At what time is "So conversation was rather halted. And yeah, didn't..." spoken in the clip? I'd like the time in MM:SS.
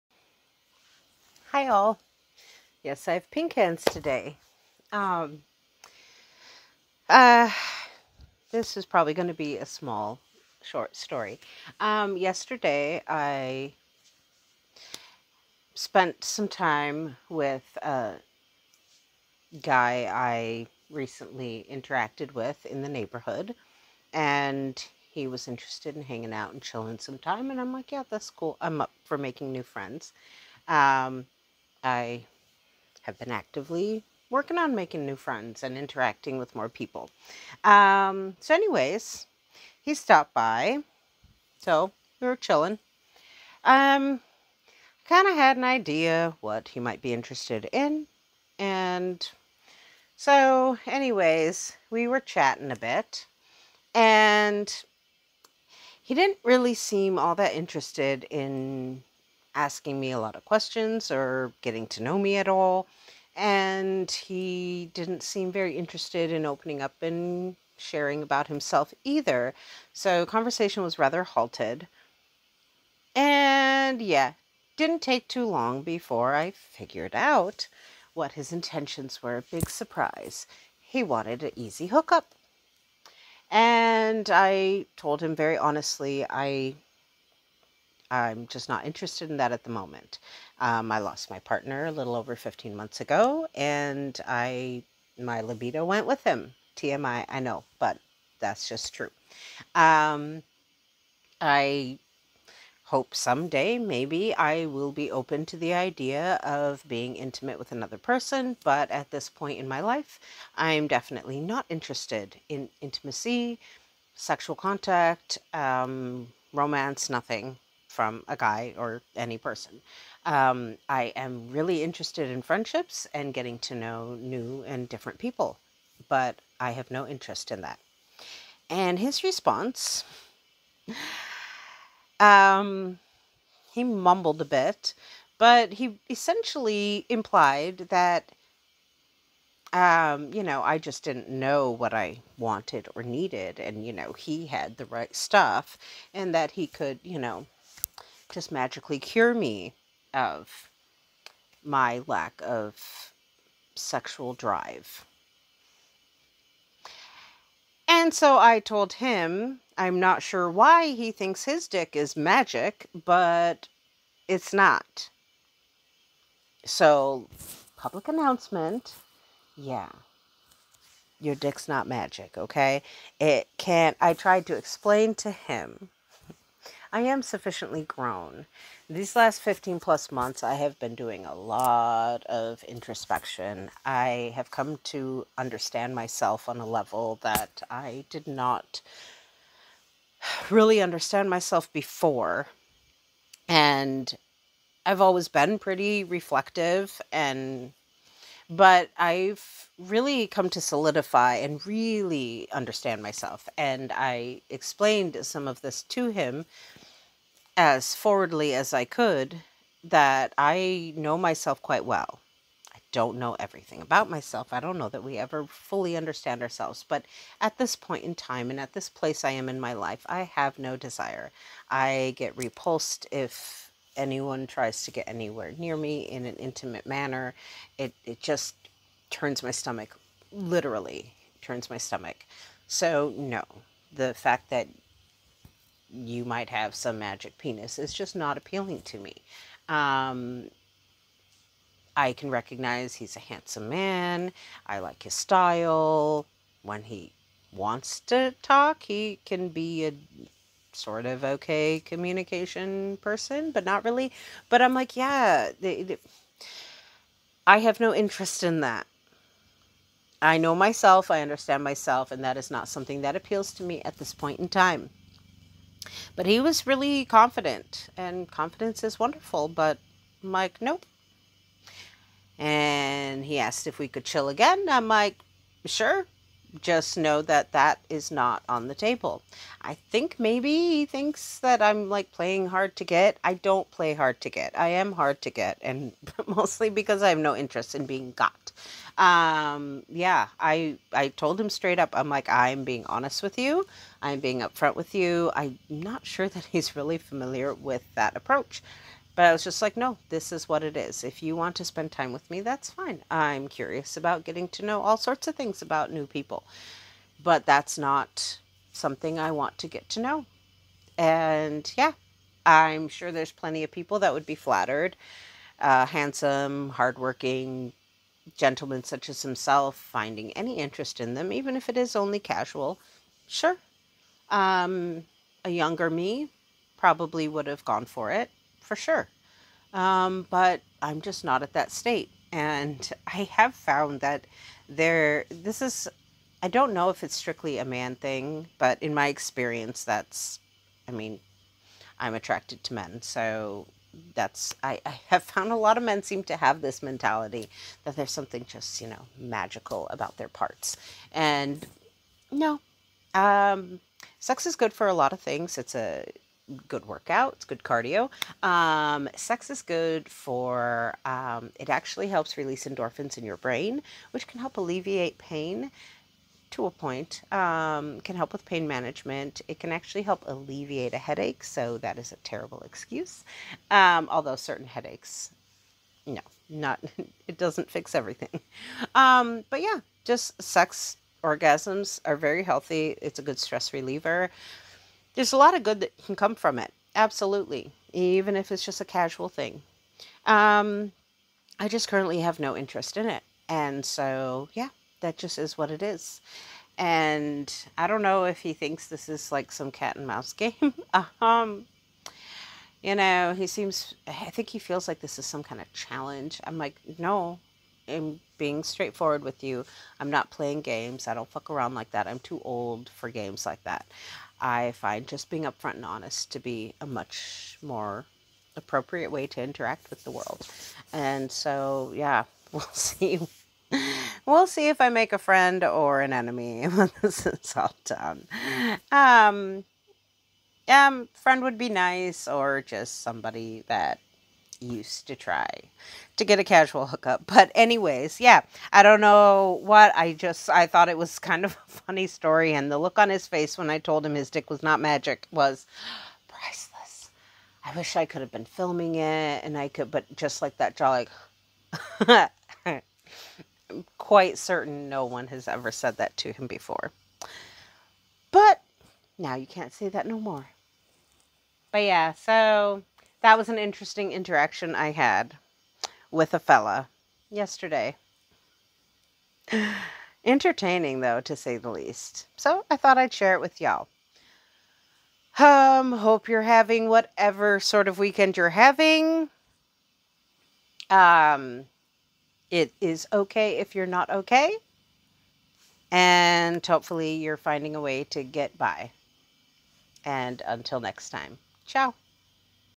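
01:09.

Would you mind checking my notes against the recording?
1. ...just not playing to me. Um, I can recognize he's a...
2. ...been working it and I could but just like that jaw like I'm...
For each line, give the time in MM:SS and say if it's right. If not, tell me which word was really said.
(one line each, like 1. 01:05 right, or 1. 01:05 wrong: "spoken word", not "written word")
1. 03:57 wrong: "appealing", not "playing"
2. 07:28 wrong: "filming", not "working".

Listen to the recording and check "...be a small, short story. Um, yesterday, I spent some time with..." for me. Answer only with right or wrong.
right.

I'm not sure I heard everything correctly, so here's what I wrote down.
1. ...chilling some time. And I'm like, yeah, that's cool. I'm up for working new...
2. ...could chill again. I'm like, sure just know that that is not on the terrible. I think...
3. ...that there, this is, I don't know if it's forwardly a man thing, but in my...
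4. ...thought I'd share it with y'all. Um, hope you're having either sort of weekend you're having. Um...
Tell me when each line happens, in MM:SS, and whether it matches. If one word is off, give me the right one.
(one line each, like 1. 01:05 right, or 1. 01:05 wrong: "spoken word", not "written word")
1. 00:26 wrong: "making", not "working"
2. 04:33 wrong: "table", not "terrible"
3. 05:33 wrong: "strictly", not "forwardly"
4. 07:52 wrong: "whatever", not "either".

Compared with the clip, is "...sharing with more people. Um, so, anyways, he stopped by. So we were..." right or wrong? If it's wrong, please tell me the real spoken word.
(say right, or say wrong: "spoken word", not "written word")
wrong: "interacting", not "sharing".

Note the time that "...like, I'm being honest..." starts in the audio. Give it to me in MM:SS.
04:52.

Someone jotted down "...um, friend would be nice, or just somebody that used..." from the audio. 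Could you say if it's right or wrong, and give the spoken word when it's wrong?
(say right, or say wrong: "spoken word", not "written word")
right.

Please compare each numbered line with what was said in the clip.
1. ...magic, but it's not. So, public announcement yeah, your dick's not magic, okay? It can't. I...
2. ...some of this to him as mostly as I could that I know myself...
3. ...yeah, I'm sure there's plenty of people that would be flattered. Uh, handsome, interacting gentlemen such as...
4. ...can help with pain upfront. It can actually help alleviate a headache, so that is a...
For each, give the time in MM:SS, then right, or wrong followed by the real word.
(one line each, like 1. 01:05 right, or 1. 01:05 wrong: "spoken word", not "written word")
1. 02:42 right
2. 03:25 wrong: "forwardly", not "mostly"
3. 05:11 wrong: "hardworking", not "interacting"
4. 06:08 wrong: "management", not "upfront".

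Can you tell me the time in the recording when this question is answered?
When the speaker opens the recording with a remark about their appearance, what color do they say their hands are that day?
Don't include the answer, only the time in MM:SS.
00:03.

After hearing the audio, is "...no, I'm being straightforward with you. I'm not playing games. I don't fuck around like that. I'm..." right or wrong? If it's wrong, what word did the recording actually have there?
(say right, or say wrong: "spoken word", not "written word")
right.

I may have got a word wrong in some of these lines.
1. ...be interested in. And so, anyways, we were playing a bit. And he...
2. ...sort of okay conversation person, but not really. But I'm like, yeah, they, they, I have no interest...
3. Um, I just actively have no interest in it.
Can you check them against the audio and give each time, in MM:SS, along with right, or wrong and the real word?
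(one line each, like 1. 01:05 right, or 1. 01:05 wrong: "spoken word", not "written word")
1. 00:47 wrong: "chatting", not "playing"
2. 04:10 wrong: "communication", not "conversation"
3. 06:30 wrong: "currently", not "actively".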